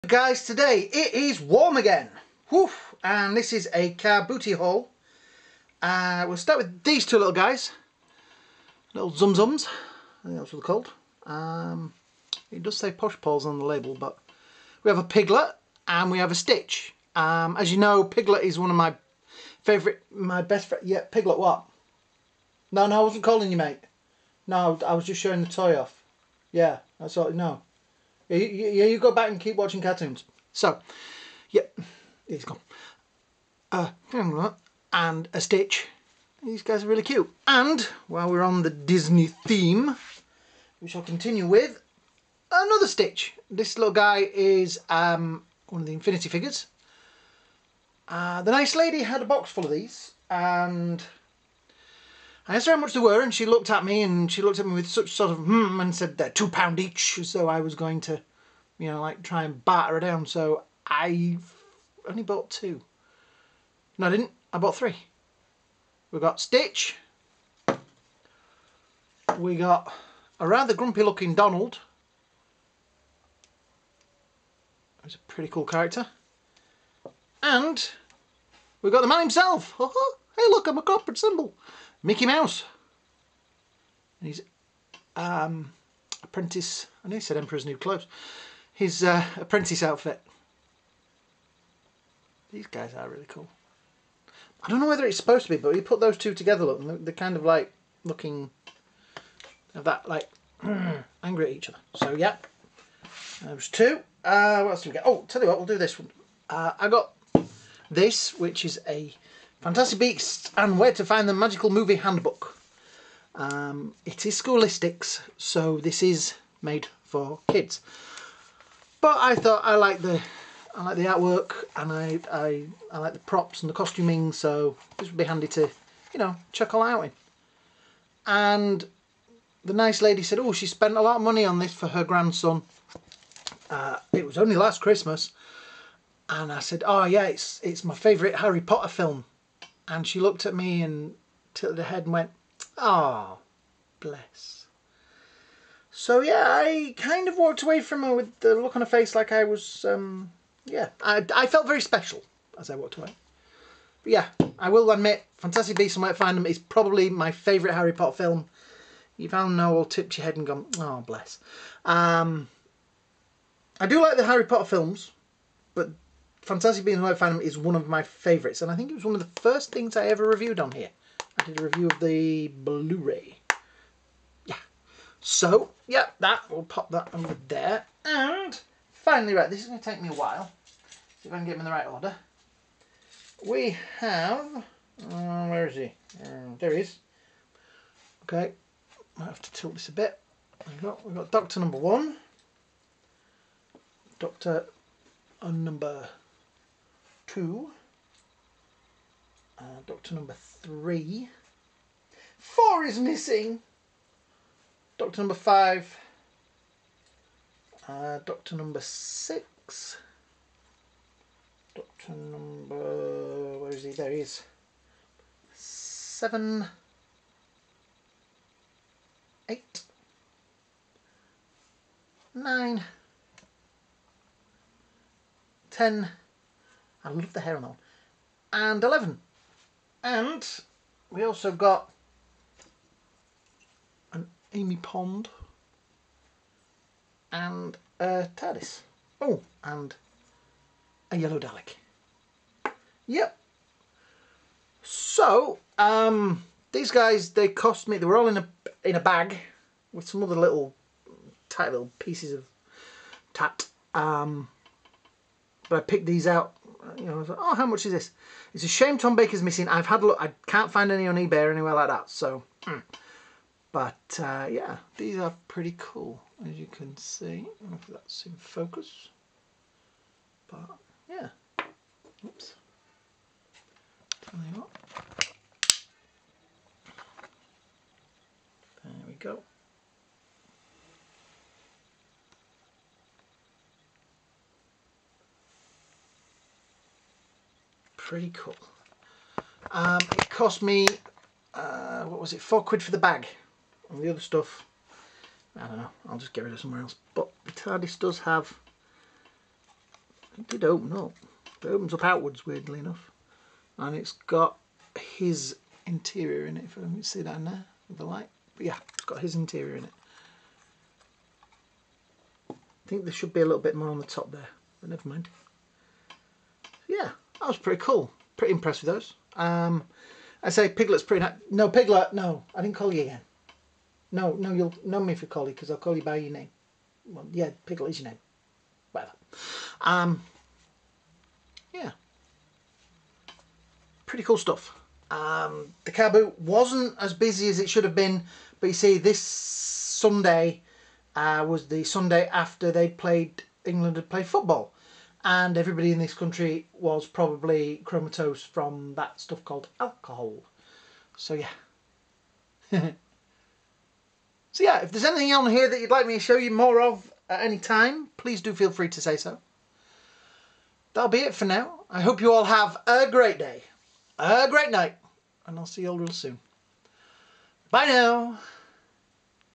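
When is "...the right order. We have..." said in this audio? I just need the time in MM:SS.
03:01.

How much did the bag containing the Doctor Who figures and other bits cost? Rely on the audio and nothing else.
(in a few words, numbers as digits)
£4.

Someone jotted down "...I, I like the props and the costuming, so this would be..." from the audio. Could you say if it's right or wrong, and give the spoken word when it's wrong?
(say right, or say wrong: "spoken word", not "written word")
right.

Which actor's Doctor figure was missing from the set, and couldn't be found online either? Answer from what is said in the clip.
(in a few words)
Tom Baker.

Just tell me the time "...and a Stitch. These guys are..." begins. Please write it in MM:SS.
00:34.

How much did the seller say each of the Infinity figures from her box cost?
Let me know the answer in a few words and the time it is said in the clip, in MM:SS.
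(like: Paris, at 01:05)
£2 each, at 00:56.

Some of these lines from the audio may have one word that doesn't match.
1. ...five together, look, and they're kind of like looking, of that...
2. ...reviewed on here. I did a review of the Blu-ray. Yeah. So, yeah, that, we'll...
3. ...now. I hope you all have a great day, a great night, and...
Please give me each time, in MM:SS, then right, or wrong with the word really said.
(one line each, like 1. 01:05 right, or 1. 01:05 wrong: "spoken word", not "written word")
1. 01:36 wrong: "two", not "five"
2. 02:50 right
3. 06:01 right.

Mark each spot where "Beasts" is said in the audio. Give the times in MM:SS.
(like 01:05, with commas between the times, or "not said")
01:49, 02:35, 02:46.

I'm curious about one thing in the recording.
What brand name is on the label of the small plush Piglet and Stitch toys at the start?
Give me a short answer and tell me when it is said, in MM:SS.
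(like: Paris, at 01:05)
Posh Paws, at 00:12.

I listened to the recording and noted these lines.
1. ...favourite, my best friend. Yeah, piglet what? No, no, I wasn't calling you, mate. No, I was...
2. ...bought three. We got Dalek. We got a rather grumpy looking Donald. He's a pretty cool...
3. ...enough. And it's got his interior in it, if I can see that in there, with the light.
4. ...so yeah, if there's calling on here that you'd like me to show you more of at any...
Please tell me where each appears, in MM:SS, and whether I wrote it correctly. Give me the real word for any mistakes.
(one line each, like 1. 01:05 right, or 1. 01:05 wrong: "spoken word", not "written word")
1. 00:19 right
2. 01:04 wrong: "Stitch", not "Dalek"
3. 05:02 right
4. 05:52 wrong: "anything", not "calling".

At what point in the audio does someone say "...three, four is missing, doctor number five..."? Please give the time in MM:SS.
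03:20.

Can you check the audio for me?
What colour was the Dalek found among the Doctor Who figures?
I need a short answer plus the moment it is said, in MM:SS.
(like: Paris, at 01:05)
Yellow, at 04:01.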